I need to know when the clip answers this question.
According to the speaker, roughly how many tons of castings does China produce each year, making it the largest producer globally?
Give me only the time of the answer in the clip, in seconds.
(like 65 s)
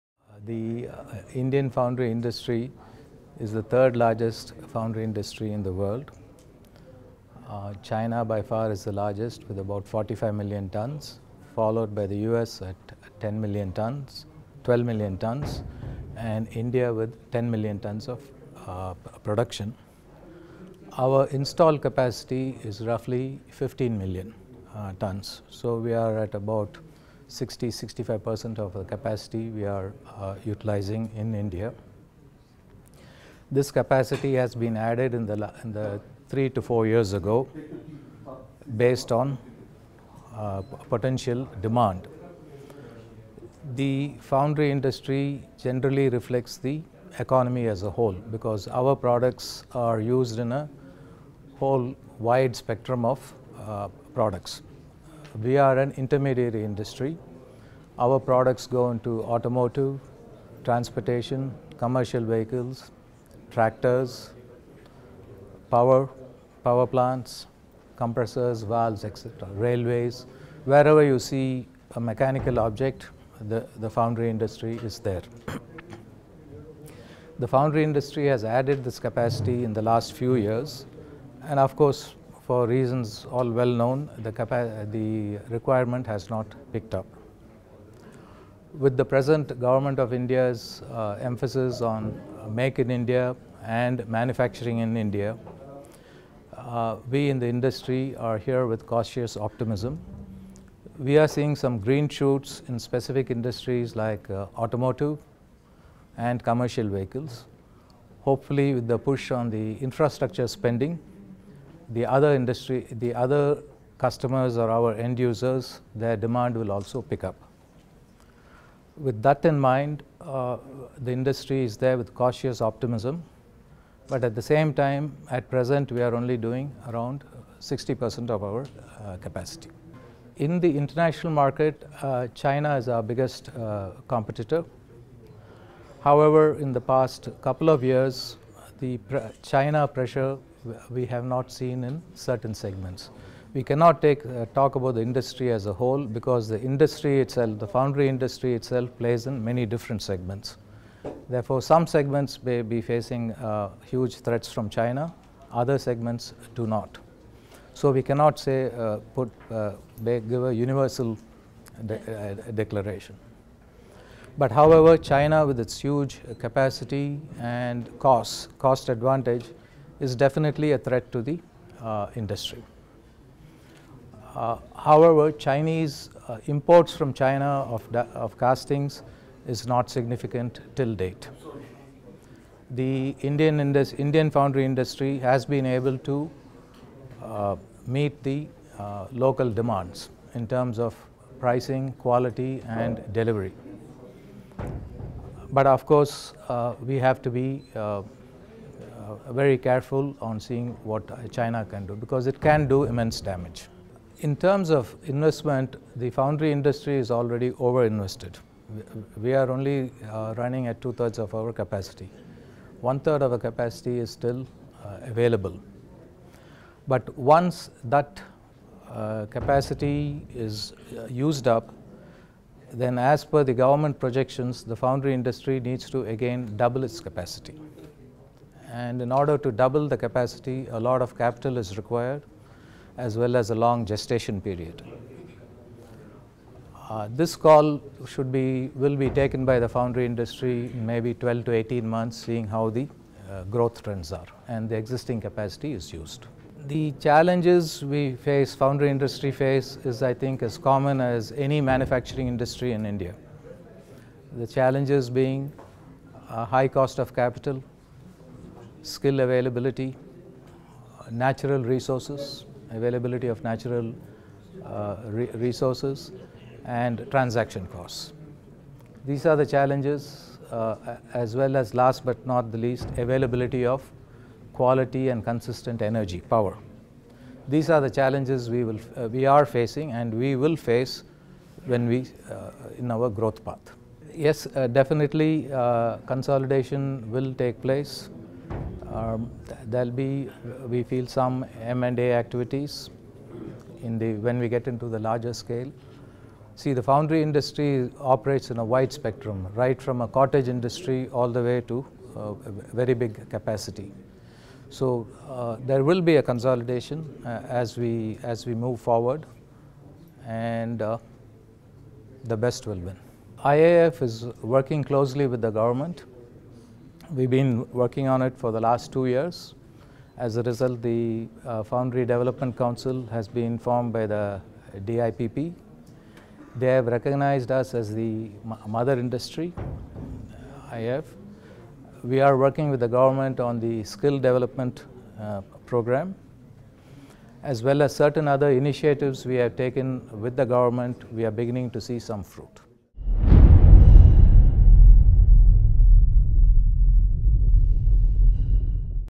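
9 s.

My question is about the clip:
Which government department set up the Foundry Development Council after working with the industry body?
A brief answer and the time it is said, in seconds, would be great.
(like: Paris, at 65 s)
DIPP, at 324 s.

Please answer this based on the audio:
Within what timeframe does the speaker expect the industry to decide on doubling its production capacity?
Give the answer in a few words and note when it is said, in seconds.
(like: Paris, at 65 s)
12 to 18 months, at 241 s.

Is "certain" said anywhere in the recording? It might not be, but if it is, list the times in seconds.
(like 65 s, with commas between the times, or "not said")
142 s, 337 s.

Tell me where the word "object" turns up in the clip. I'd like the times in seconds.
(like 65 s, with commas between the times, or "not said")
72 s.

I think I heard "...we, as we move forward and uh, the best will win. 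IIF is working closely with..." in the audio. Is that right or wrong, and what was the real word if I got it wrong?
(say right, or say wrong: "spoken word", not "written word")
right.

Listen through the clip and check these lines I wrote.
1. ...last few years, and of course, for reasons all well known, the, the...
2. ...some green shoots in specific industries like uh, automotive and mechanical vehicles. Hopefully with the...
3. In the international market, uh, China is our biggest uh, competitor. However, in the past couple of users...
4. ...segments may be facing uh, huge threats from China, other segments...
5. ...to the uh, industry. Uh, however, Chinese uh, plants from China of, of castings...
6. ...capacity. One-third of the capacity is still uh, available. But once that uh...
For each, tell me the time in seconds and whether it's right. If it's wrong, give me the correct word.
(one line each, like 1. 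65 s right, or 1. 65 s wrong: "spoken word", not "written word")
1. 79 s right
2. 101 s wrong: "commercial", not "mechanical"
3. 130 s wrong: "years", not "users"
4. 151 s right
5. 171 s wrong: "imports", not "plants"
6. 211 s right.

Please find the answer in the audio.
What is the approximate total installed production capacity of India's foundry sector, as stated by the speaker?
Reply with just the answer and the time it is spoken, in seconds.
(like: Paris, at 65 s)
15 million tons, at 23 s.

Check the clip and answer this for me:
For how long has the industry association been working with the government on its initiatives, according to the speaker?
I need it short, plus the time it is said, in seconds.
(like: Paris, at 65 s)
2 years, at 318 s.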